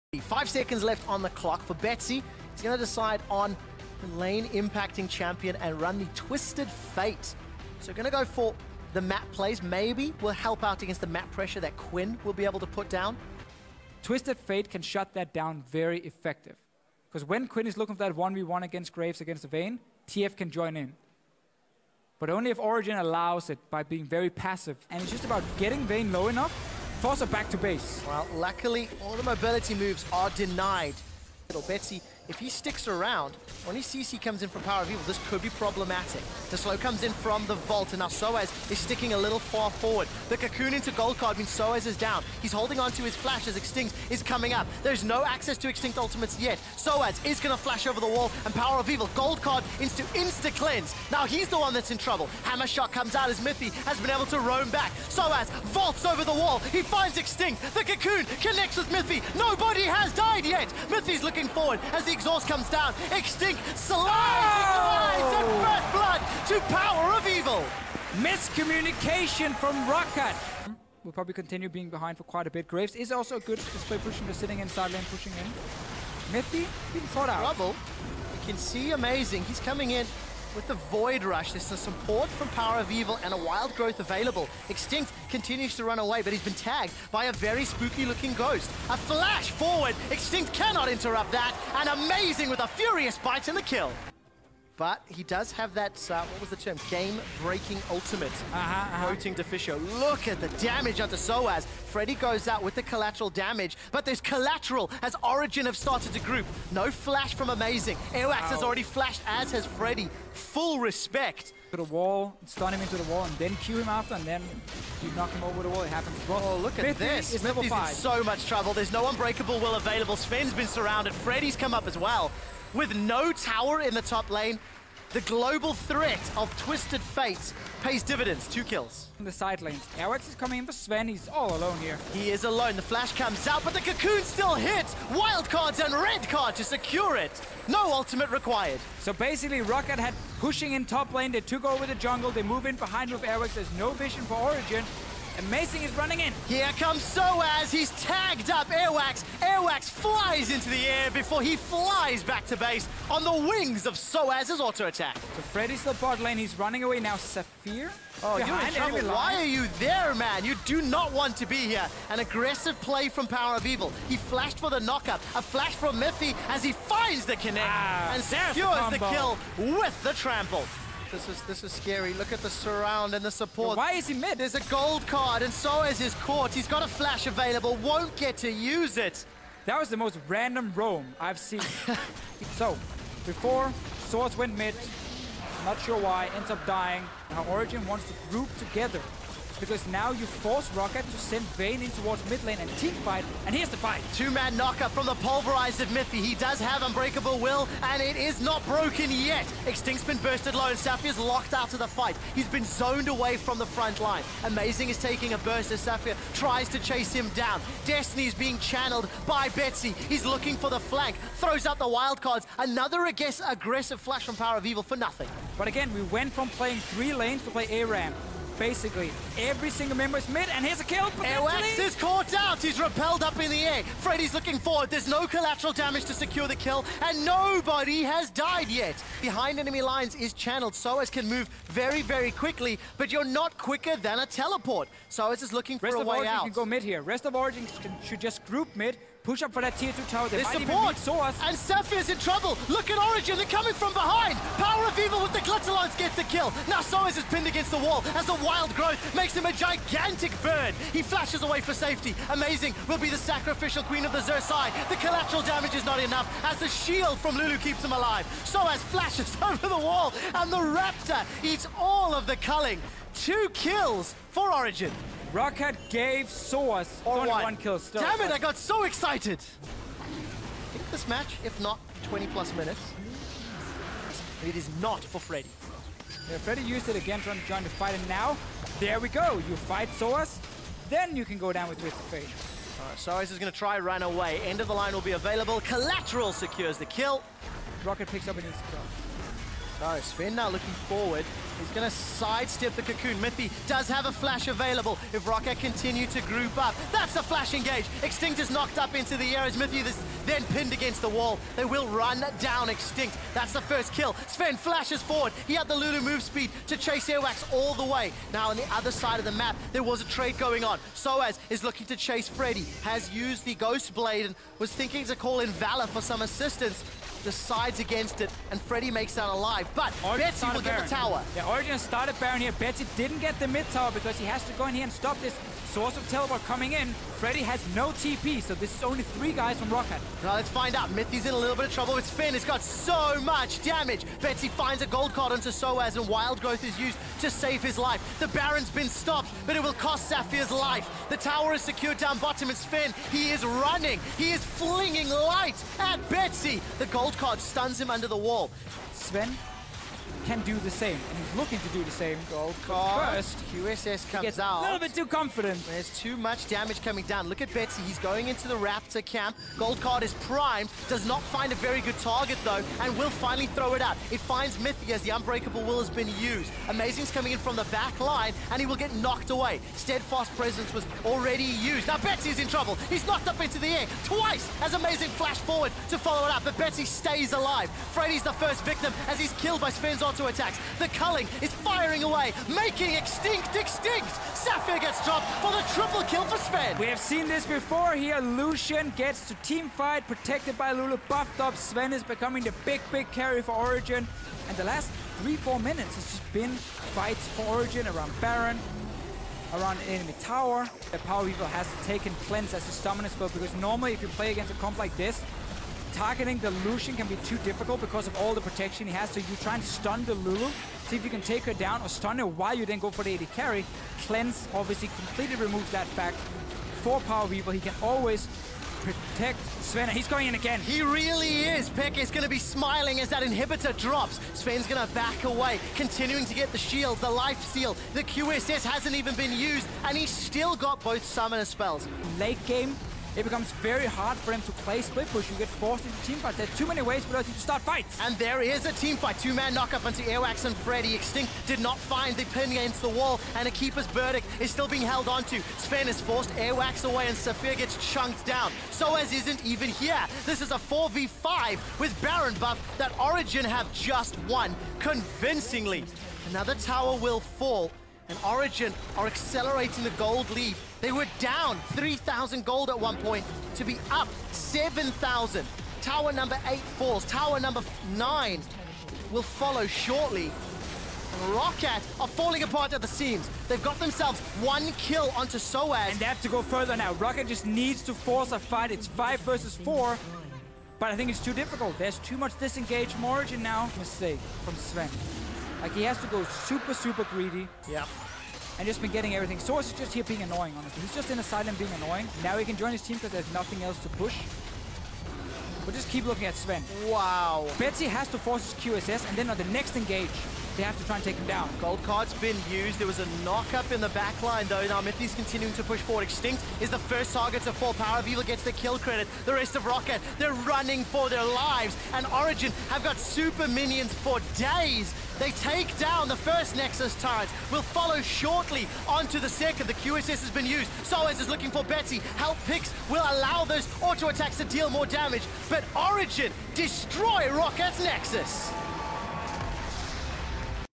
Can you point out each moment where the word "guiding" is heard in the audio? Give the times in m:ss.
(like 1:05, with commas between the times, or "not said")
not said.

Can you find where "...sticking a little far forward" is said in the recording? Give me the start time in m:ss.
0:38.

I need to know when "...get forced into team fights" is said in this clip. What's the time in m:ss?
7:15.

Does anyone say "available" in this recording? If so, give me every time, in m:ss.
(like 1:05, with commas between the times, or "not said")
1:23, 1:59, 2:57, 4:45, 4:54.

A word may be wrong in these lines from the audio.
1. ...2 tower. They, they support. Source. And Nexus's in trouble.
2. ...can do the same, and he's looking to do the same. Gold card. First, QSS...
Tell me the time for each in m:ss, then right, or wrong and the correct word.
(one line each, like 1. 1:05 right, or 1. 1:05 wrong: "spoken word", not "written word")
1. 3:59 wrong: "Safir", not "Nexus"
2. 5:50 right.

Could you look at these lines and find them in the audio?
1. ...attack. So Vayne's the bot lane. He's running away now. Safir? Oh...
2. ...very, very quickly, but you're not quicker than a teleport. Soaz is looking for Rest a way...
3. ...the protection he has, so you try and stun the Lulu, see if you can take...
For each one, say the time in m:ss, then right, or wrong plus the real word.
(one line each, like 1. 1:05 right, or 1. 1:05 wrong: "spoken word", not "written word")
1. 2:34 wrong: "Fredy", not "Vayne"
2. 3:51 right
3. 6:48 right.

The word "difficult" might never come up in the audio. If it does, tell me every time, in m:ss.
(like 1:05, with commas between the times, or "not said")
6:47, 8:01.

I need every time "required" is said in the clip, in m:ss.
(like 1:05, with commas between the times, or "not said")
2:18.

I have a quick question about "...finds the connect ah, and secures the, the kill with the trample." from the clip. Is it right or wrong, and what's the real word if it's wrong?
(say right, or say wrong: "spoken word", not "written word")
right.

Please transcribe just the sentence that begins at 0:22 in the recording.
But only if Origen allows it by being very passive.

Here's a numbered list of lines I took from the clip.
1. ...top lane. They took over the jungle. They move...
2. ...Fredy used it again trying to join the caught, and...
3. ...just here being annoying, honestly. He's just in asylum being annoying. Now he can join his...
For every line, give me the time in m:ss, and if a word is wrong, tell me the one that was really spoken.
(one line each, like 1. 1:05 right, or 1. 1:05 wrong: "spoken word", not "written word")
1. 2:20 right
2. 4:36 wrong: "fight", not "caught"
3. 8:09 right.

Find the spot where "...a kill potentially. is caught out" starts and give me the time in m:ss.
3:40.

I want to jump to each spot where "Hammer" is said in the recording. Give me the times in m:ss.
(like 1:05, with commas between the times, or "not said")
0:52.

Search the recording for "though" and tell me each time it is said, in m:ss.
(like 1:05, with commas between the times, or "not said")
6:02, 8:24.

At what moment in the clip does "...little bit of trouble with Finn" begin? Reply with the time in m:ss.
5:31.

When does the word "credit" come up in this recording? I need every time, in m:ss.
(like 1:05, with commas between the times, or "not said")
8:28.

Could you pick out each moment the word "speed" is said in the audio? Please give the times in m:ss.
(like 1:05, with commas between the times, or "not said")
5:06.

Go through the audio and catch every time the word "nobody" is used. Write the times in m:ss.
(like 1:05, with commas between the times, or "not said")
0:59, 3:47.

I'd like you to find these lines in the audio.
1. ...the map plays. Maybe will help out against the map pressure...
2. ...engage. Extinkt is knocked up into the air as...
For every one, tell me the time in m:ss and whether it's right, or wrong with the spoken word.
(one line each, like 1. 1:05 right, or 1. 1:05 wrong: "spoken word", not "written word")
1. 0:08 right
2. 4:57 right.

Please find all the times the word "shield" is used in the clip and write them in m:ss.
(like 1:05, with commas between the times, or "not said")
4:16, 7:06.